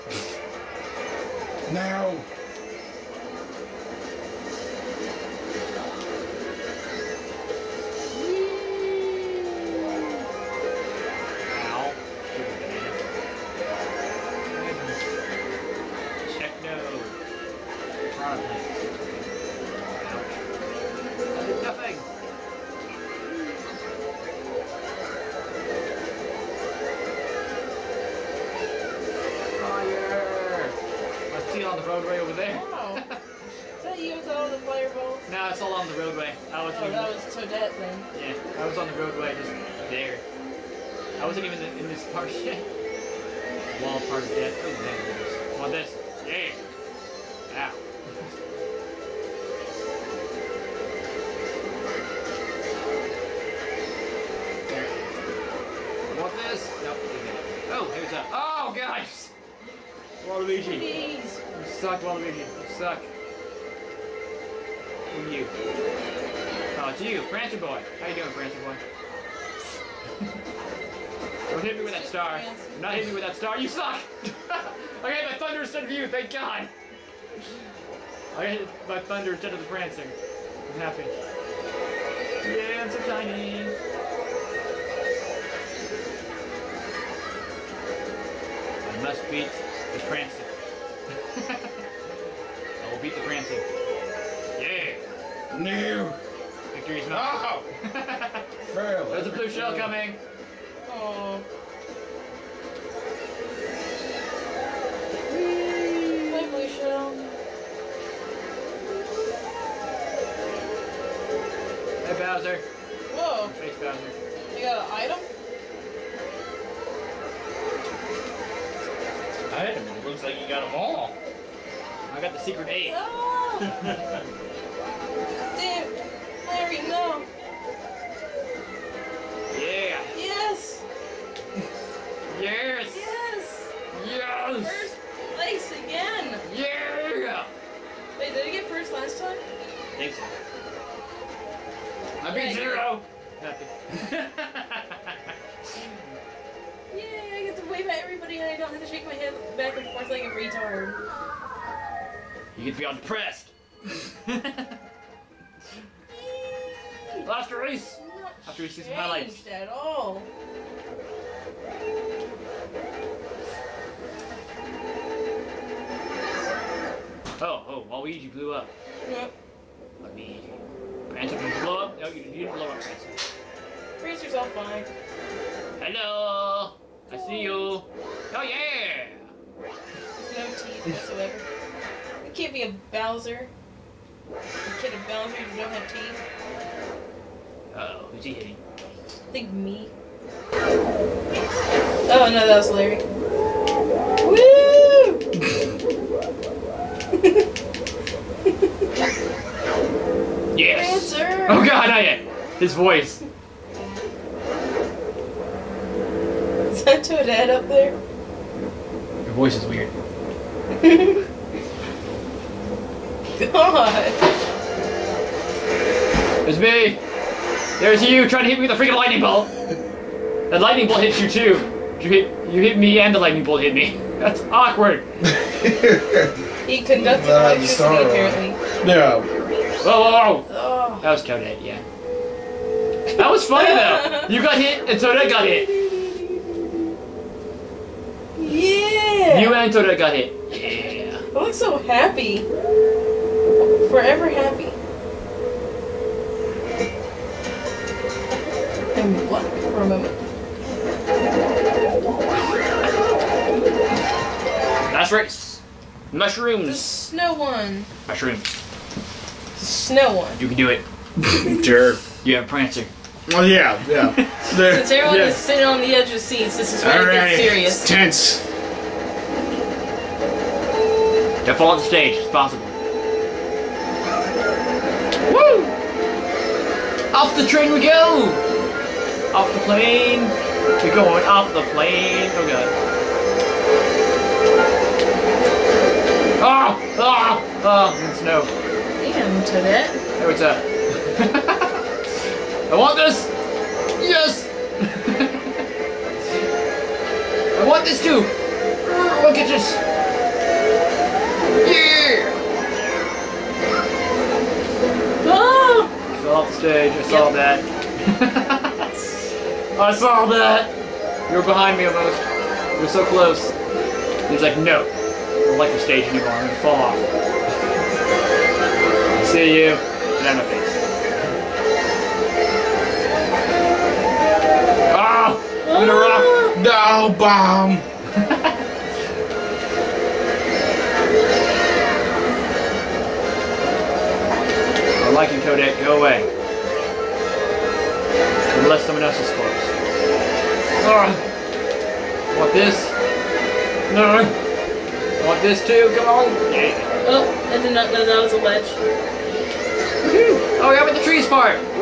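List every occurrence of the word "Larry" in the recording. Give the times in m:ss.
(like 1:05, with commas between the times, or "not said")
2:06, 3:12.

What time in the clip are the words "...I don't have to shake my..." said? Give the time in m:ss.
2:28.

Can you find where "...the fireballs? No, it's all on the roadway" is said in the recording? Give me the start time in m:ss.
0:34.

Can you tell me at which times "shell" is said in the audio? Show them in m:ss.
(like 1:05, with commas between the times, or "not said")
1:39, 1:46.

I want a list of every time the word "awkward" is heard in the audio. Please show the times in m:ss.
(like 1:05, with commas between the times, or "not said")
3:44.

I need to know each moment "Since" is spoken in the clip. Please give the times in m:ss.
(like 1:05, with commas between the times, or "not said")
4:24.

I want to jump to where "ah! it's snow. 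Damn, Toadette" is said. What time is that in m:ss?
4:47.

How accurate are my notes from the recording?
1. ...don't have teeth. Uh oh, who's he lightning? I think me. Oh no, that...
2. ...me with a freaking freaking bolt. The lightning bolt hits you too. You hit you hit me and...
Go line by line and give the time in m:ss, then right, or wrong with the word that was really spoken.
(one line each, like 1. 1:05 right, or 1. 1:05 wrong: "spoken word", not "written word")
1. 3:05 wrong: "hitting", not "lightning"
2. 3:38 wrong: "lightning", not "freaking".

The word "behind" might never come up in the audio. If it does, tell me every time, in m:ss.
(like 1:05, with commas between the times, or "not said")
5:11.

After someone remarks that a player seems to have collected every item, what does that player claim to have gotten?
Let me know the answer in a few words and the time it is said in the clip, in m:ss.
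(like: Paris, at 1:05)
the secret eight, at 2:02.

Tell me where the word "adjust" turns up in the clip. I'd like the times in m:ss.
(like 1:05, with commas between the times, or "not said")
not said.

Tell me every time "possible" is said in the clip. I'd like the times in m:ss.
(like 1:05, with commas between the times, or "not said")
4:32.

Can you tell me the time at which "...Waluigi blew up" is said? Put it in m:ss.
2:47.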